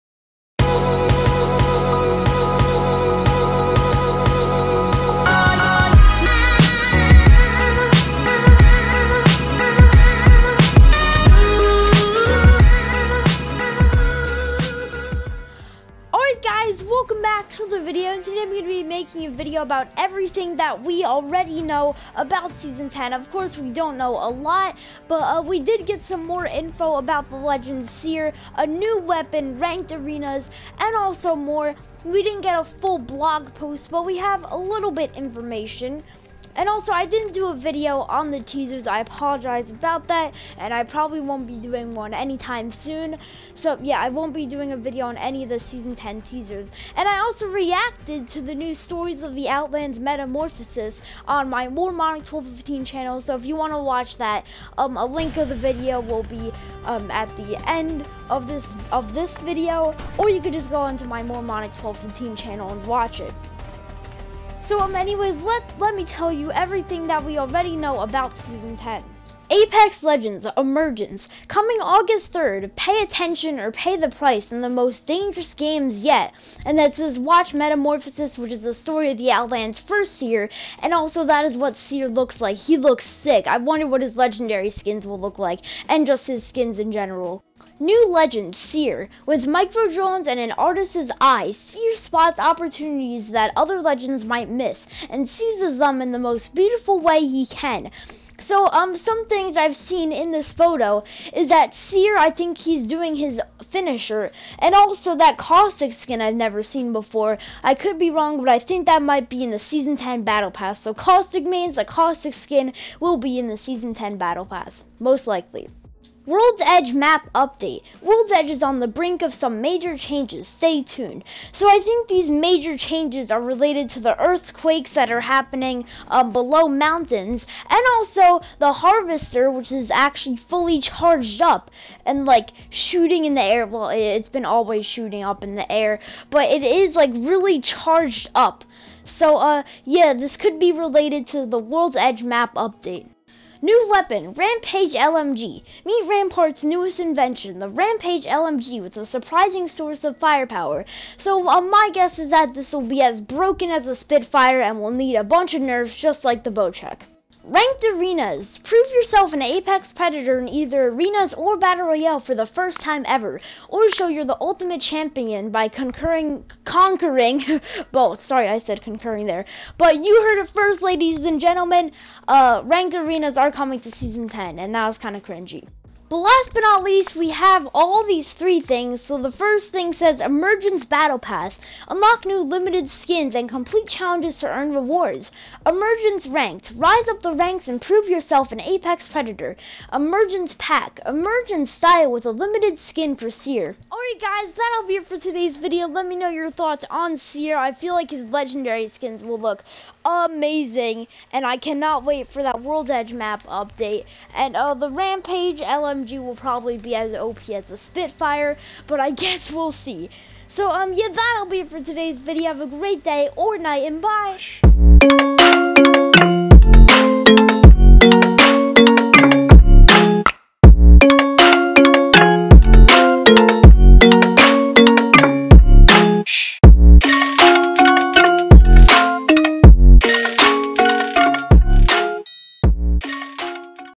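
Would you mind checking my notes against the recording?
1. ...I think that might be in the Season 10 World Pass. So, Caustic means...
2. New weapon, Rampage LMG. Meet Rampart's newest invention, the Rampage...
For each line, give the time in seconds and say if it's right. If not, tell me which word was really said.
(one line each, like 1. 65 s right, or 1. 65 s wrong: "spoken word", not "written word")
1. 108 s wrong: "Battle", not "World"
2. 143 s right.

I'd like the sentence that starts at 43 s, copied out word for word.
So, yeah, I won't be doing a video on any of the Season 10 teasers.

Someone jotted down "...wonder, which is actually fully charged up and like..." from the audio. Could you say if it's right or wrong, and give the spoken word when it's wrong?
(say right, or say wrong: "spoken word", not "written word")
wrong: "harvester", not "wonder".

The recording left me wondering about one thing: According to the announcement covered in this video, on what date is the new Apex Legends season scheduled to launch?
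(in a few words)
August 3rd.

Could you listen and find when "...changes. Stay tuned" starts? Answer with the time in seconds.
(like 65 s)
119 s.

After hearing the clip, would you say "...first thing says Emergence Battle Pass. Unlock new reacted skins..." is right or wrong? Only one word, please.
wrong.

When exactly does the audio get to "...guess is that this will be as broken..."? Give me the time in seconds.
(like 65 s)
151 s.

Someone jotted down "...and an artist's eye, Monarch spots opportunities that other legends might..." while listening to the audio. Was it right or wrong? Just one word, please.
wrong.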